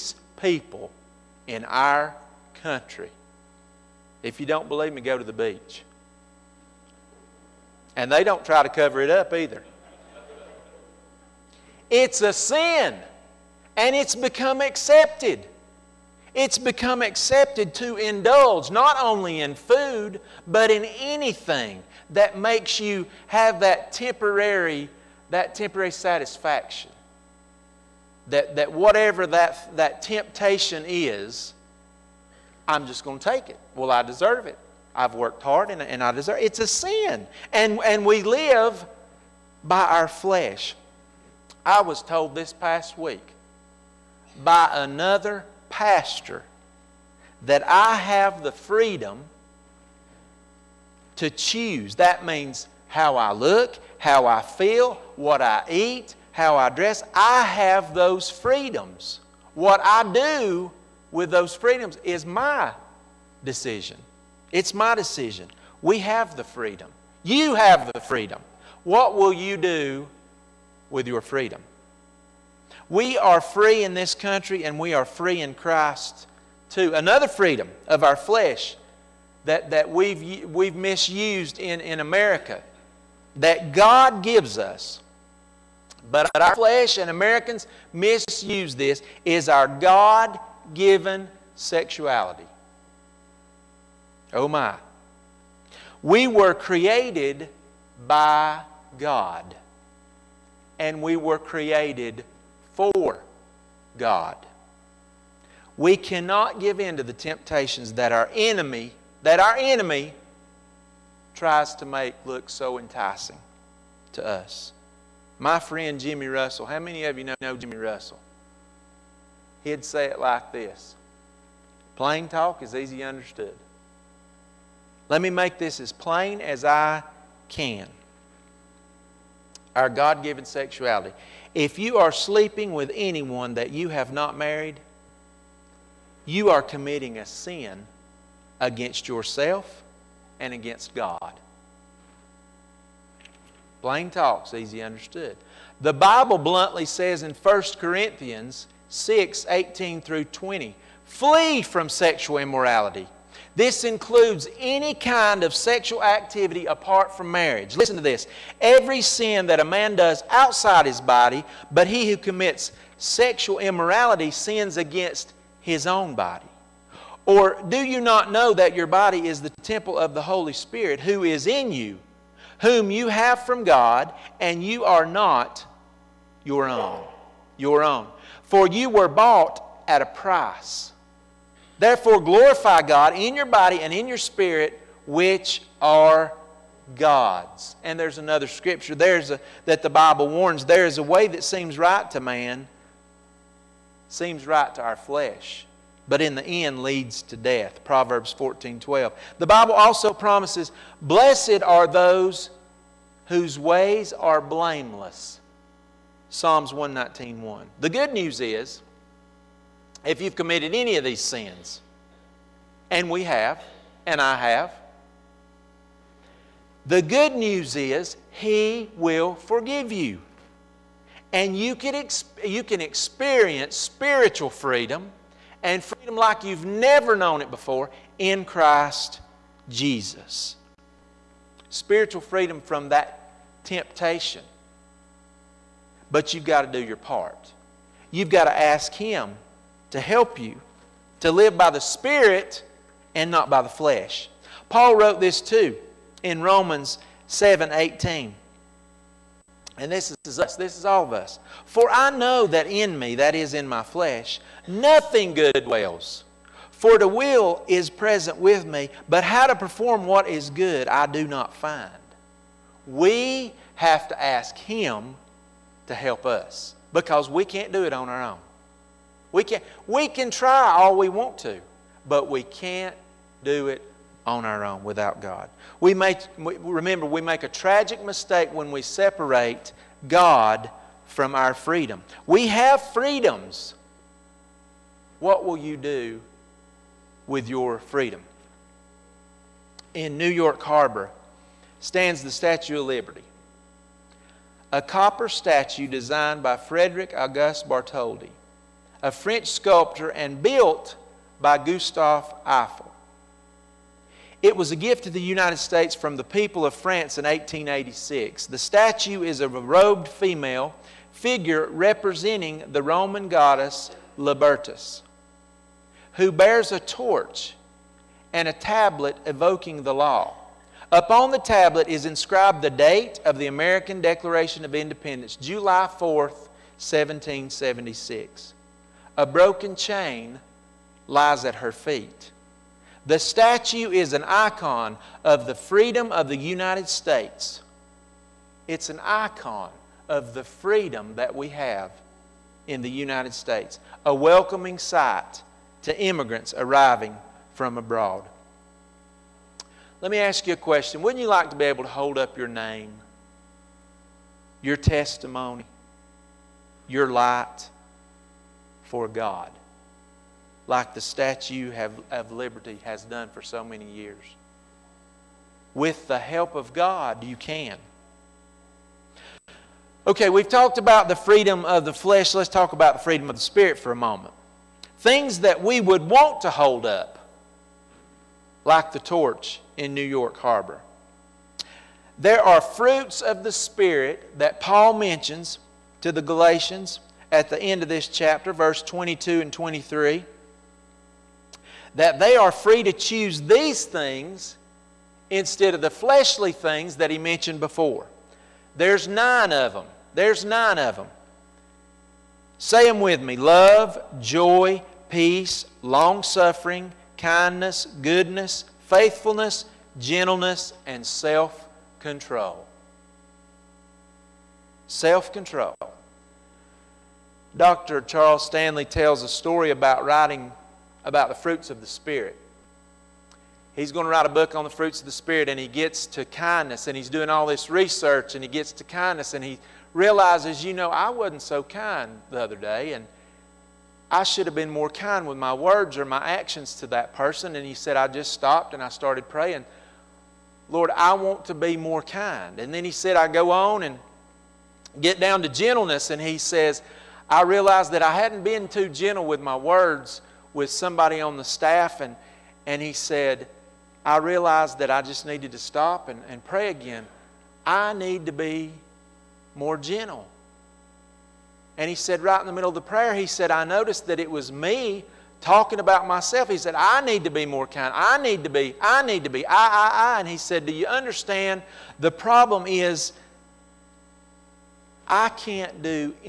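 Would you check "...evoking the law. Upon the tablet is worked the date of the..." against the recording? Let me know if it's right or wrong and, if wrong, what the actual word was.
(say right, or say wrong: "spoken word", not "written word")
wrong: "inscribed", not "worked".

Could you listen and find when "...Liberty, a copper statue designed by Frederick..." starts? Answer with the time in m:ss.
4:52.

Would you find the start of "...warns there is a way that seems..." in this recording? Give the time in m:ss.
3:10.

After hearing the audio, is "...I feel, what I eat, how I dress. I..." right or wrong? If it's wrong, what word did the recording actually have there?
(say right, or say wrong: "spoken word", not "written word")
right.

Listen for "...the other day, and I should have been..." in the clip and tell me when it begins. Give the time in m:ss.
7:12.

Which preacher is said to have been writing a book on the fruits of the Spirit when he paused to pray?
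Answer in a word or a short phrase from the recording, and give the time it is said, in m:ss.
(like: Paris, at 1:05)
Dr. Charles Stanley, at 6:57.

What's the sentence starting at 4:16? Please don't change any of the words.
For the will is present with me, but how to perform what is good I do not find.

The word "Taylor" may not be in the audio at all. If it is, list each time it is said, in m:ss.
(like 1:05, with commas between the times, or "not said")
not said.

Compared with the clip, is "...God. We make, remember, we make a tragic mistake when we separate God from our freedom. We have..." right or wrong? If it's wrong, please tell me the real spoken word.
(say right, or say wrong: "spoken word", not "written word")
right.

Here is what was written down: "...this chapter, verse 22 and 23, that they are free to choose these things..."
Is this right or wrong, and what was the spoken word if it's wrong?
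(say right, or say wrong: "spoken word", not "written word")
right.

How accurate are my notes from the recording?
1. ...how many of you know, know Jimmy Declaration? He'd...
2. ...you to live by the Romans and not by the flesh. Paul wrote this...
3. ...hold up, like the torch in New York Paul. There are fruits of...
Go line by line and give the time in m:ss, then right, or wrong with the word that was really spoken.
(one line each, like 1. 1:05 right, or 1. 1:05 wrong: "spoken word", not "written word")
1. 1:56 wrong: "Russell", not "Declaration"
2. 4:00 wrong: "Spirit", not "Romans"
3. 6:16 wrong: "Harbor", not "Paul".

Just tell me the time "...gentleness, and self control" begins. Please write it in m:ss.
6:49.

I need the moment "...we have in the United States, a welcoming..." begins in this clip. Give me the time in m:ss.
5:41.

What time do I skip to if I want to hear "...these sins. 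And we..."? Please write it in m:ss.
3:31.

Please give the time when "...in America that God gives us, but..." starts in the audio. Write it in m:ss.
1:21.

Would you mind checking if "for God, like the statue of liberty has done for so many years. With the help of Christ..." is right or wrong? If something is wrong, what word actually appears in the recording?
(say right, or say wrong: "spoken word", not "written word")
wrong: "God", not "Christ".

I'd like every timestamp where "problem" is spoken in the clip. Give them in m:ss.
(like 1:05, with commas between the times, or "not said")
7:52.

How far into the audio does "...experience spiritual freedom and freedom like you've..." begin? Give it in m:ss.
3:42.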